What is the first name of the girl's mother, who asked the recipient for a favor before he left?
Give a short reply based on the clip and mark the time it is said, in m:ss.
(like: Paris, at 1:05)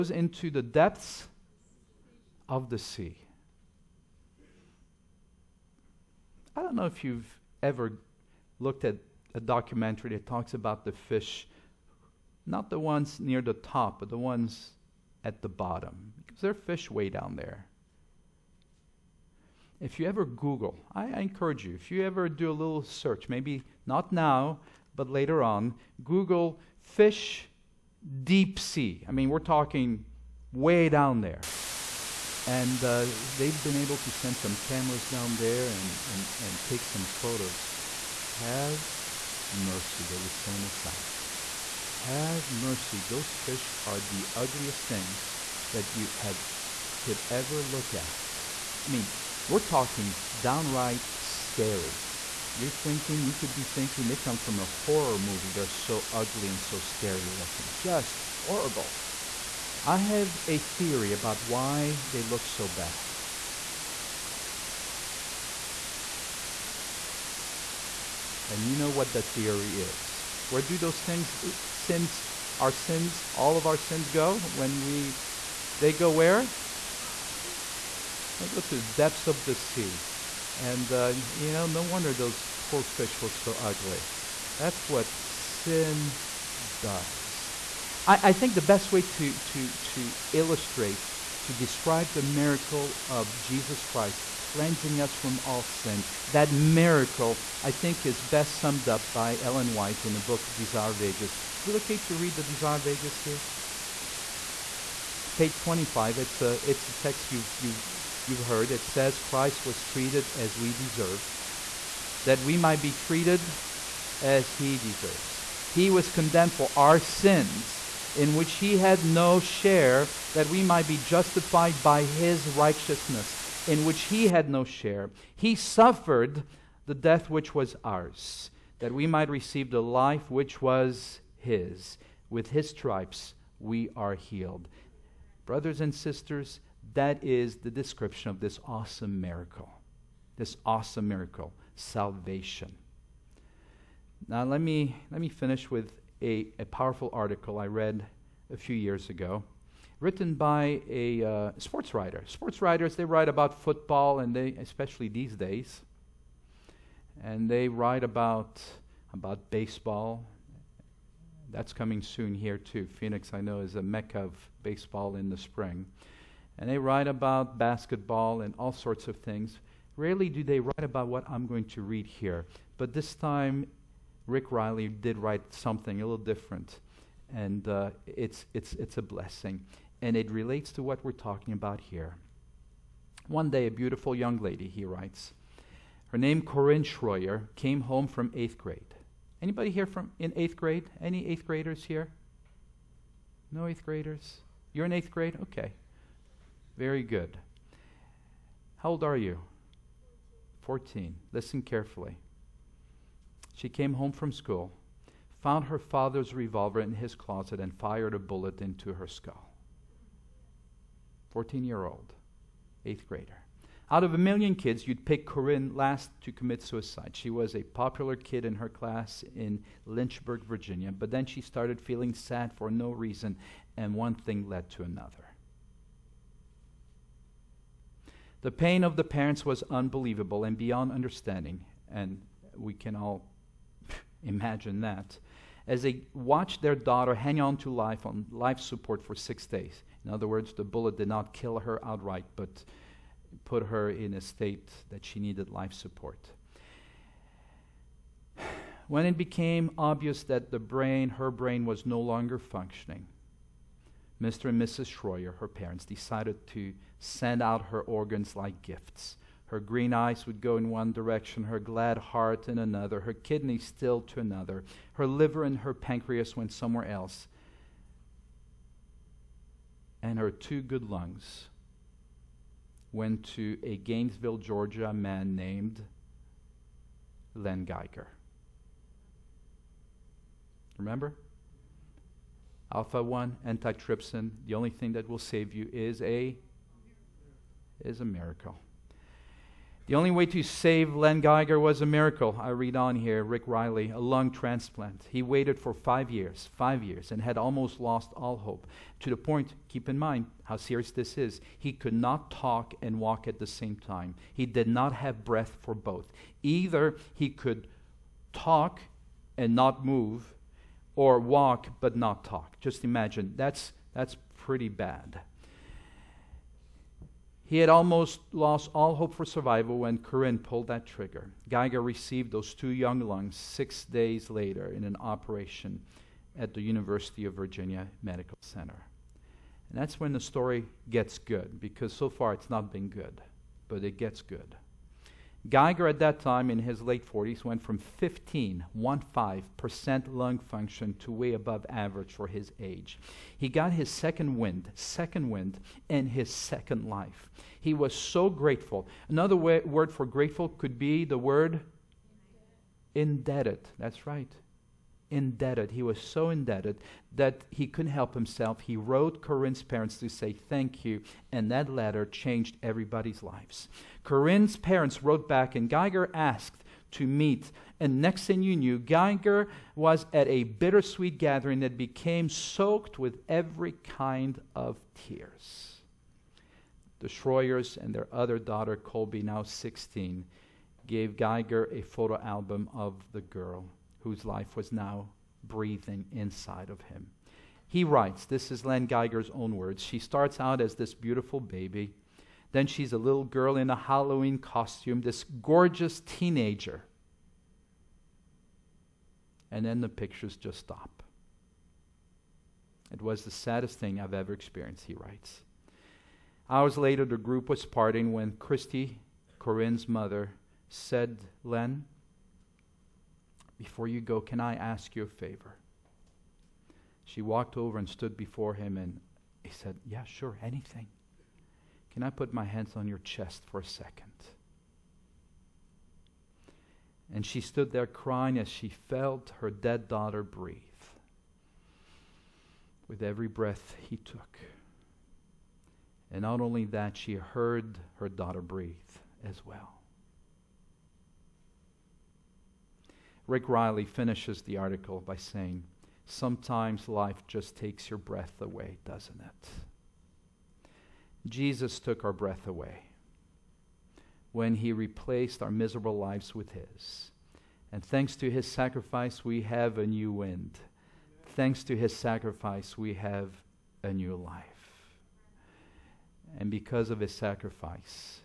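Christy, at 6:48.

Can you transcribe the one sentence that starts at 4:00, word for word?
In other words, the bullet did not kill her outright, but put her in a state that she needed life support.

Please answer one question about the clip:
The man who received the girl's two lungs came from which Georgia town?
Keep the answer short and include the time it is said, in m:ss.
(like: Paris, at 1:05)
Gainesville, at 4:33.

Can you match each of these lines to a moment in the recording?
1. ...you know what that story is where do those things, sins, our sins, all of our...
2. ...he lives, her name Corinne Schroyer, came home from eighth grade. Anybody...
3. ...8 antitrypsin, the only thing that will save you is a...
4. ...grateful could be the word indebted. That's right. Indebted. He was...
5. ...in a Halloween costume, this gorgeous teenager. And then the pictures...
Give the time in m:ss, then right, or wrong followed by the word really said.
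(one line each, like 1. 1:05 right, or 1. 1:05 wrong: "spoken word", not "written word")
1. 1:08 wrong: "theory", not "story"
2. 3:04 wrong: "writes", not "lives"
3. 4:43 wrong: "1", not "8"
4. 5:50 right
5. 6:33 right.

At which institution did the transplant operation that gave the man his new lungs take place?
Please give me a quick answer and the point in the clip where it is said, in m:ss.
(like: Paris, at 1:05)
University of Virginia Medical Center, at 5:26.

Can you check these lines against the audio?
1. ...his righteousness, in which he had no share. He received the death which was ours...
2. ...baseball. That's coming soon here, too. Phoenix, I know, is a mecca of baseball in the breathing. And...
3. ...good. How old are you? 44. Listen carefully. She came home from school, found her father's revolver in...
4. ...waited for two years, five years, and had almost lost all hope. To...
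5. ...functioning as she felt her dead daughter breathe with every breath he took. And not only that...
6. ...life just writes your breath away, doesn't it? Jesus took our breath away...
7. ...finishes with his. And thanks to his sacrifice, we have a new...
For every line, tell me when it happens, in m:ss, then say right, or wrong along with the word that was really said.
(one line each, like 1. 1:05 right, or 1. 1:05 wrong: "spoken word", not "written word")
1. 2:02 wrong: "suffered", not "received"
2. 2:39 wrong: "spring", not "breathing"
3. 3:17 wrong: "14", not "44"
4. 4:55 wrong: "five", not "two"
5. 7:07 wrong: "crying", not "functioning"
6. 7:26 wrong: "takes", not "writes"
7. 7:35 wrong: "lives", not "finishes".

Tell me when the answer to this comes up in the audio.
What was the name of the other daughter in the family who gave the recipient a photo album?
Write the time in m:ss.
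6:18.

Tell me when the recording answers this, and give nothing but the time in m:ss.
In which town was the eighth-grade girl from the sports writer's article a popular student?
3:39.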